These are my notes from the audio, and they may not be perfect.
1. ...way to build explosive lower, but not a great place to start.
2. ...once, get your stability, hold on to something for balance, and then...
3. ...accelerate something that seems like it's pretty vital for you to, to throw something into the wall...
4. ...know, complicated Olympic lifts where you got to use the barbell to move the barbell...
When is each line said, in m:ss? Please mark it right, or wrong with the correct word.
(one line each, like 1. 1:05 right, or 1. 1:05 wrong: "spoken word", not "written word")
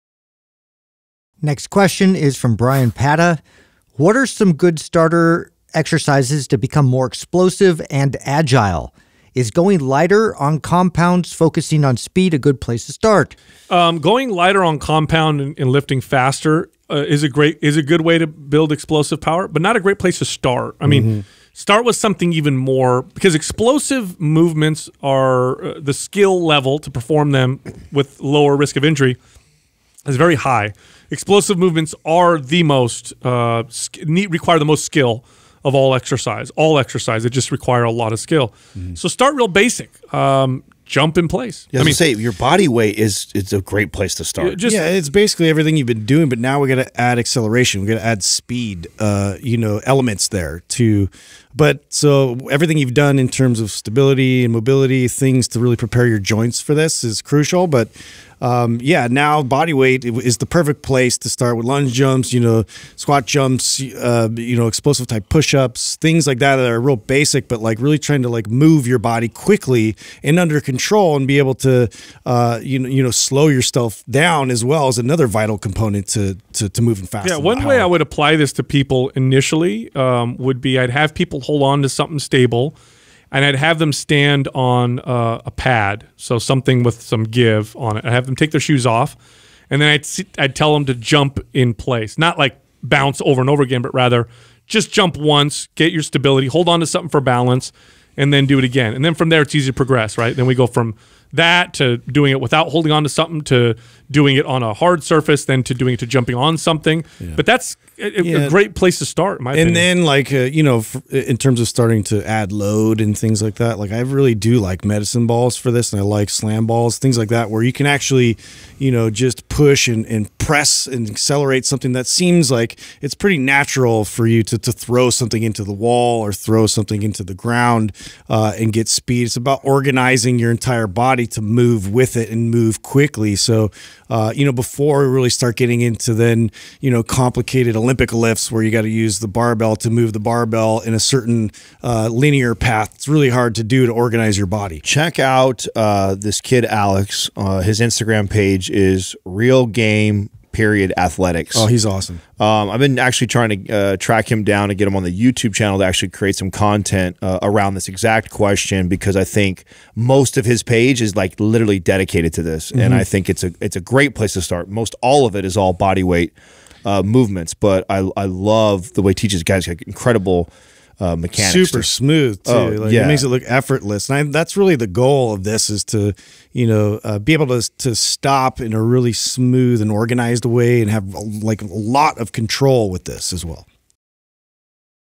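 1. 0:18 wrong: "power", not "lower"
2. 1:35 right
3. 2:01 wrong: "natural", not "vital"
4. 2:16 right.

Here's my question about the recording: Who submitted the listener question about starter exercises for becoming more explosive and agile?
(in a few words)
Brian Pata.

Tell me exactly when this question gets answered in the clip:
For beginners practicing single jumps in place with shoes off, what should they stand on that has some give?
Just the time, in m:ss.
1:25.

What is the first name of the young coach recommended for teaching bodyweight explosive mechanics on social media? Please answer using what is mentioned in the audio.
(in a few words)
Alex.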